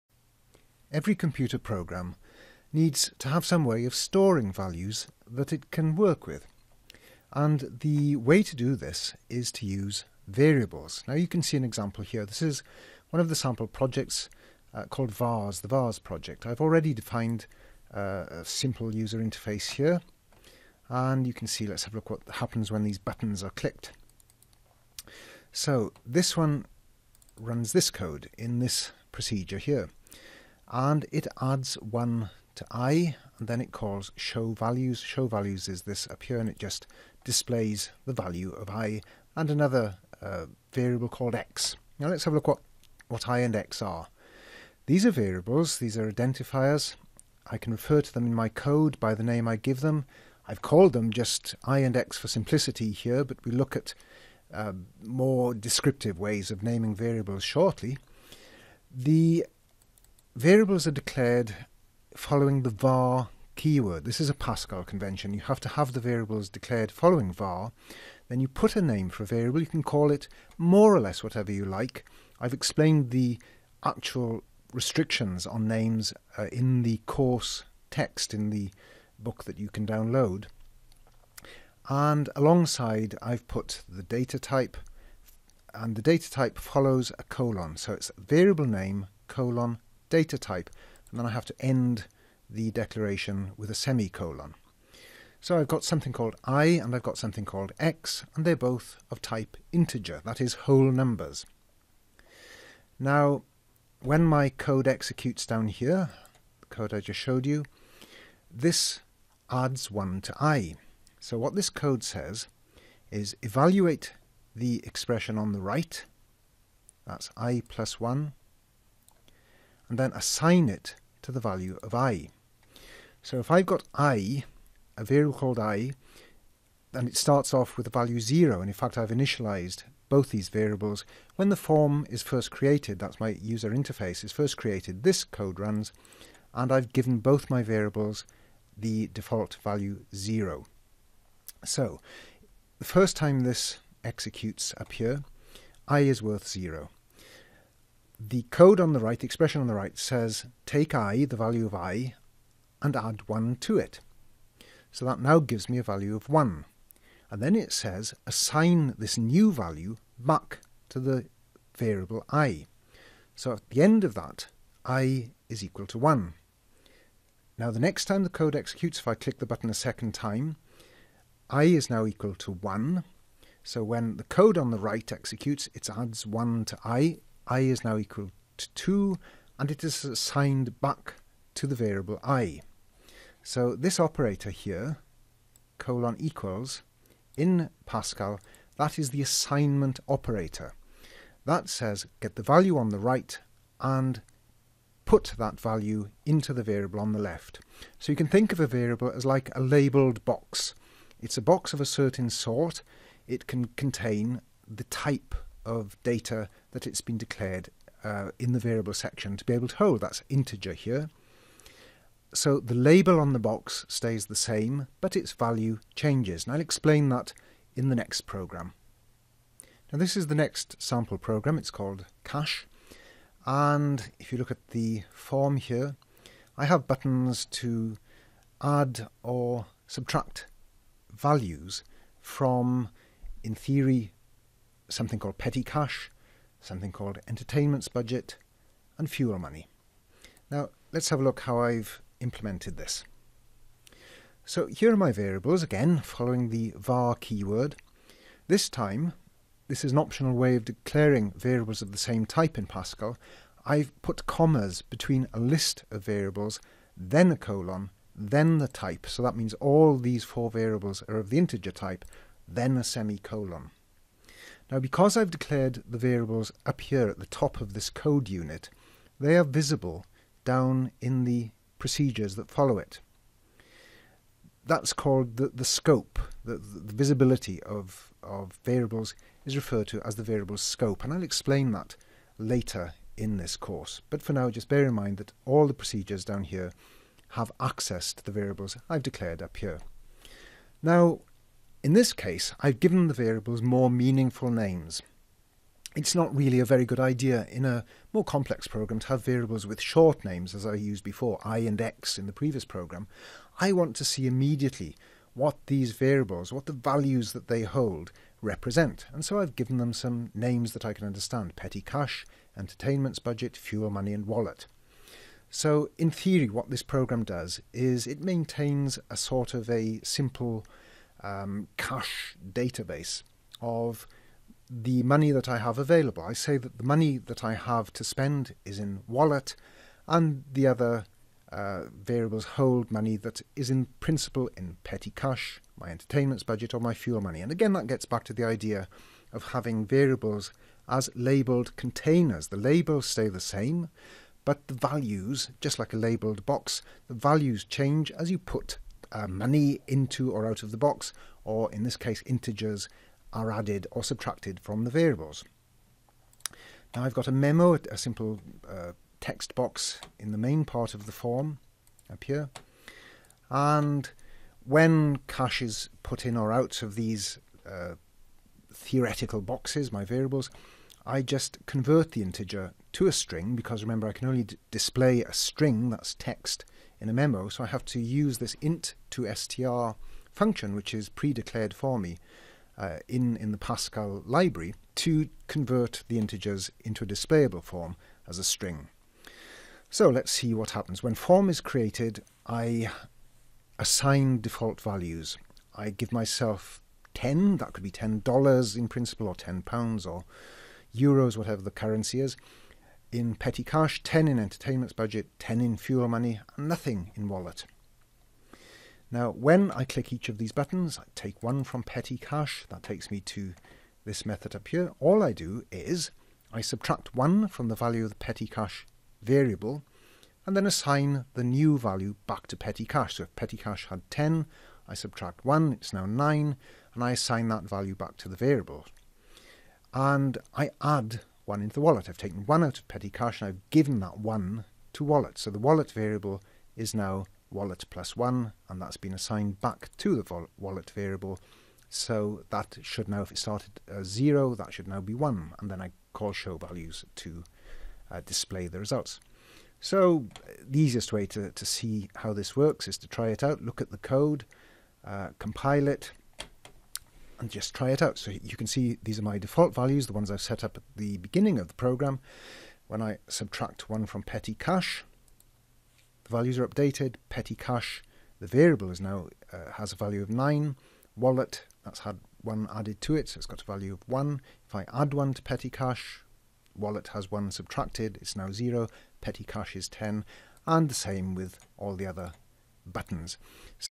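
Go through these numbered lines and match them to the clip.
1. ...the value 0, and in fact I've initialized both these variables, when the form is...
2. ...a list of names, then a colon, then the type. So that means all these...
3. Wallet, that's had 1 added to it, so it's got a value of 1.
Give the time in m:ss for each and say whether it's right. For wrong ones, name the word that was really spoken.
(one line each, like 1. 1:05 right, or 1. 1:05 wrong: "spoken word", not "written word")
1. 2:07 right
2. 4:15 wrong: "variables", not "names"
3. 7:51 right.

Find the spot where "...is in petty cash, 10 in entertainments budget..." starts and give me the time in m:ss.
6:42.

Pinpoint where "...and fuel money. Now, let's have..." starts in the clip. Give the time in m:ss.
3:58.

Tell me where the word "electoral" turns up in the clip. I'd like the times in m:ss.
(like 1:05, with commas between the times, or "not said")
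not said.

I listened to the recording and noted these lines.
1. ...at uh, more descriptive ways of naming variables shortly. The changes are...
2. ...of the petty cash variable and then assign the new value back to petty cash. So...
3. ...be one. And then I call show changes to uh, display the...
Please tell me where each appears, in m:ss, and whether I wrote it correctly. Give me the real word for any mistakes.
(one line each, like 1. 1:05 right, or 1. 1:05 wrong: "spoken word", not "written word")
1. 0:53 wrong: "variables", not "changes"
2. 6:58 right
3. 7:25 wrong: "values", not "changes".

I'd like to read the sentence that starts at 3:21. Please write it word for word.
It's a box of a certain sort.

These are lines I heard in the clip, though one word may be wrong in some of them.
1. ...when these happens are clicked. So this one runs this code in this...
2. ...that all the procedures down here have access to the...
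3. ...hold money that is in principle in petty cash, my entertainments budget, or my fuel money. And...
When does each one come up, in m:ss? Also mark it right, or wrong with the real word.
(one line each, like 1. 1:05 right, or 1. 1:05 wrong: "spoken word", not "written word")
1. 0:22 wrong: "buttons", not "happens"
2. 4:45 right
3. 5:32 right.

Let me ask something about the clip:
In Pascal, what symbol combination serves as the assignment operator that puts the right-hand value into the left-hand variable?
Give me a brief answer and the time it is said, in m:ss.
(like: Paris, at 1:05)
colon equals, at 3:05.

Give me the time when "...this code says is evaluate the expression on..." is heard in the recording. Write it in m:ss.
1:51.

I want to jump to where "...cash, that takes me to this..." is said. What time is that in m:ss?
6:52.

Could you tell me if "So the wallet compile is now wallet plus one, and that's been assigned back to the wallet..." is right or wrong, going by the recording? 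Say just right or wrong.
wrong.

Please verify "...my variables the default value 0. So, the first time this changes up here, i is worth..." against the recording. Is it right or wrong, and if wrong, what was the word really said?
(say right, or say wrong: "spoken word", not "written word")
wrong: "executes", not "changes".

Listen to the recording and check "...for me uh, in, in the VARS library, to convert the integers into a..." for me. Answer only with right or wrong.
wrong.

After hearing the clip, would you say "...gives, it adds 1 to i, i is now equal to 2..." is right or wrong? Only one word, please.
wrong.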